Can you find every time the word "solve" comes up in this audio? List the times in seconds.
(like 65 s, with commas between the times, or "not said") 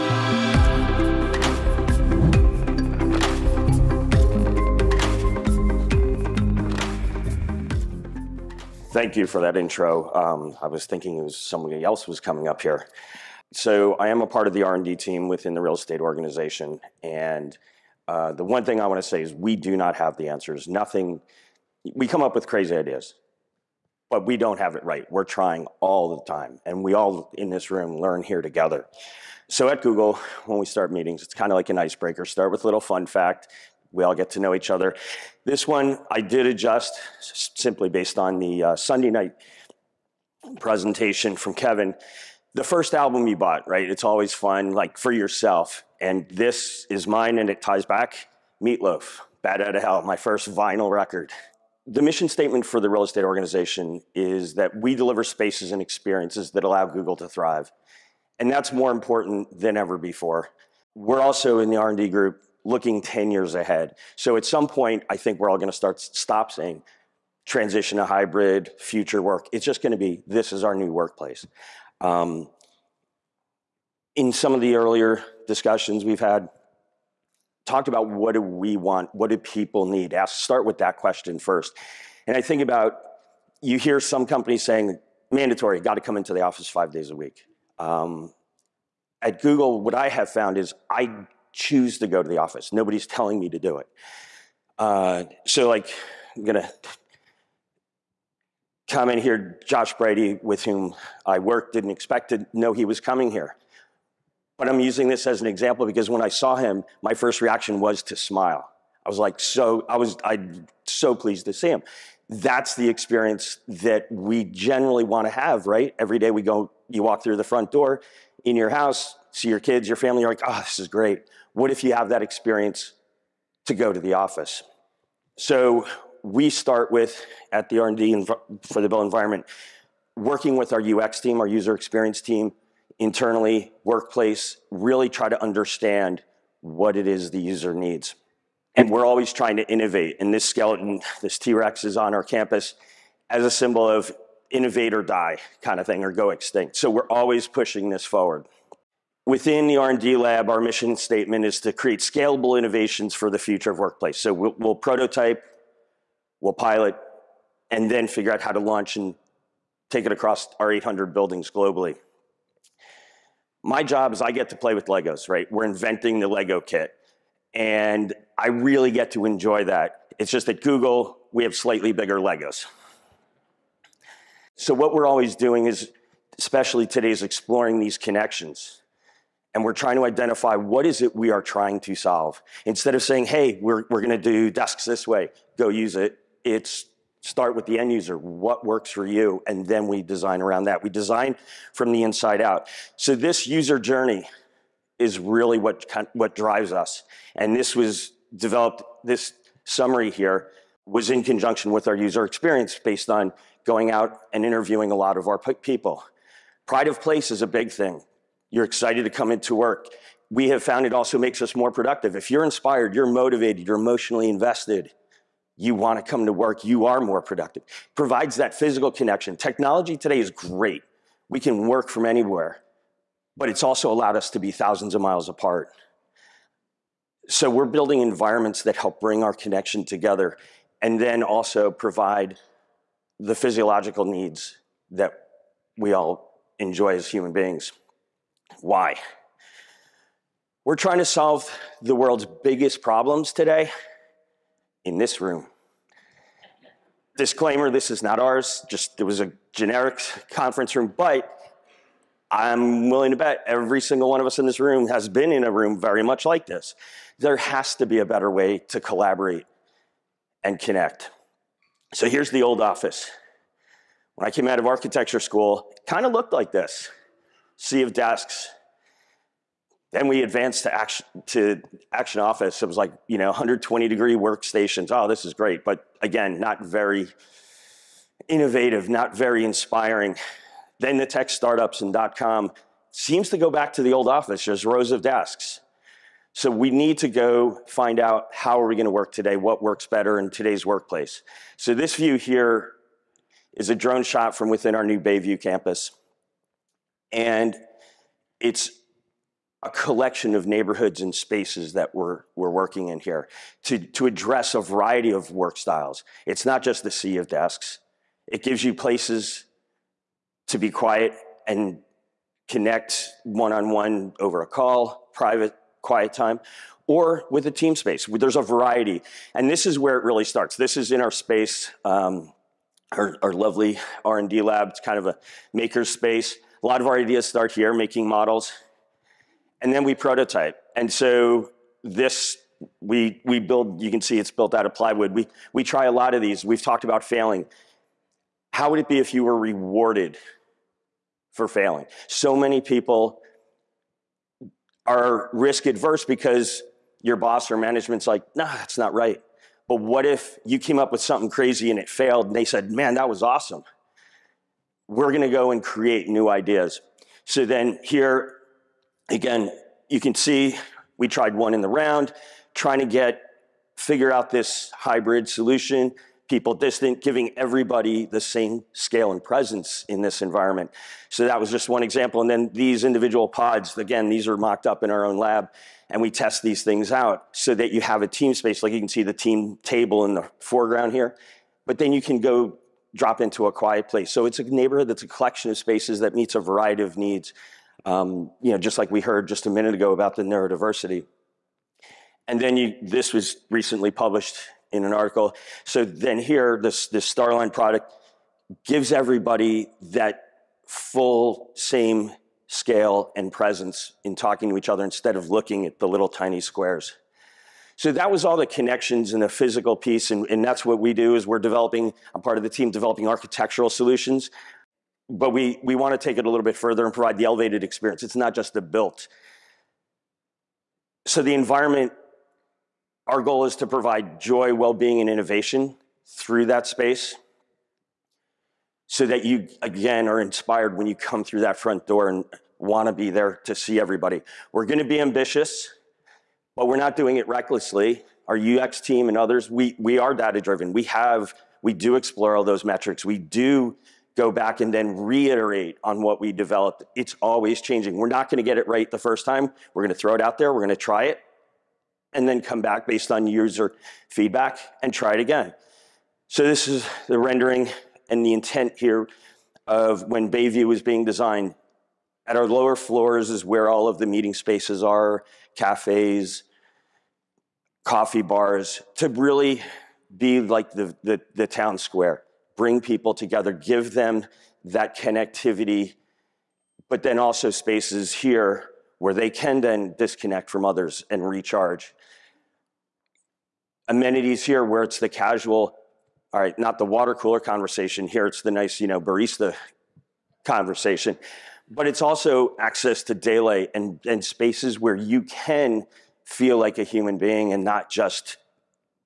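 181 s, 241 s.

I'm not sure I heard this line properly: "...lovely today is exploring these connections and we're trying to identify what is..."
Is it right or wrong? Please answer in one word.
wrong.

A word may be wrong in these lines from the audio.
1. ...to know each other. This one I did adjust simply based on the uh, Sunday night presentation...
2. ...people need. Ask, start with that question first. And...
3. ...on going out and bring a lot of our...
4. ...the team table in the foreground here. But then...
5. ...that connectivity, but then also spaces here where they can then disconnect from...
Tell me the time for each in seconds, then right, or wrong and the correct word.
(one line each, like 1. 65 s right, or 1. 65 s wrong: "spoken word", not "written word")
1. 34 s right
2. 79 s right
3. 203 s wrong: "interviewing", not "bring"
4. 379 s right
5. 474 s right.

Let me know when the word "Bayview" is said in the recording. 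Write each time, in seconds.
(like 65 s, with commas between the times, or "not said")
294 s, 460 s.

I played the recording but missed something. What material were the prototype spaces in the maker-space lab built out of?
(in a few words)
Plywood.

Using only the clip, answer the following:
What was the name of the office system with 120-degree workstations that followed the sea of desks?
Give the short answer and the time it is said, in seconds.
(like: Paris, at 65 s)
Action office, at 271 s.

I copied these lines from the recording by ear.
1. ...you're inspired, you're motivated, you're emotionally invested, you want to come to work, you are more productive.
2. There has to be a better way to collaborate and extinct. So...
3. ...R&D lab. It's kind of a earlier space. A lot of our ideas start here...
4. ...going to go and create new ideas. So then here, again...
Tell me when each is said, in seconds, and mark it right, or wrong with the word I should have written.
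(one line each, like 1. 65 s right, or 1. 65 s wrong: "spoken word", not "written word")
1. 212 s right
2. 257 s wrong: "connect", not "extinct"
3. 324 s wrong: "maker", not "earlier"
4. 355 s right.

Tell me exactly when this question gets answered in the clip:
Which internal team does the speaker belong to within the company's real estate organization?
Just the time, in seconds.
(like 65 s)
14 s.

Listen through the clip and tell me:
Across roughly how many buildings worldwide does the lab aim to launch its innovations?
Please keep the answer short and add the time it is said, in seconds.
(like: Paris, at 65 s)
800, at 160 s.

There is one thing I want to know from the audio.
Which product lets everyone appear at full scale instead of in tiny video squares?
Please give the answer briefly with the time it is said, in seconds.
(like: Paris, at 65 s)
Starline, at 397 s.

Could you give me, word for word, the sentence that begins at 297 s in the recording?
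And it's a collection of neighborhoods and spaces that we're, we're working in here to, to address a variety of work styles.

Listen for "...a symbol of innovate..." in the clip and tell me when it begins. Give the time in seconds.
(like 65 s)
143 s.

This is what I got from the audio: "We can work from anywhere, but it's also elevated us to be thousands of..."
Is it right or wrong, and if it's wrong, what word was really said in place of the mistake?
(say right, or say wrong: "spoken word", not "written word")
wrong: "allowed", not "elevated".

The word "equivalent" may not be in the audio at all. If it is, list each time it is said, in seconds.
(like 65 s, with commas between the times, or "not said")
not said.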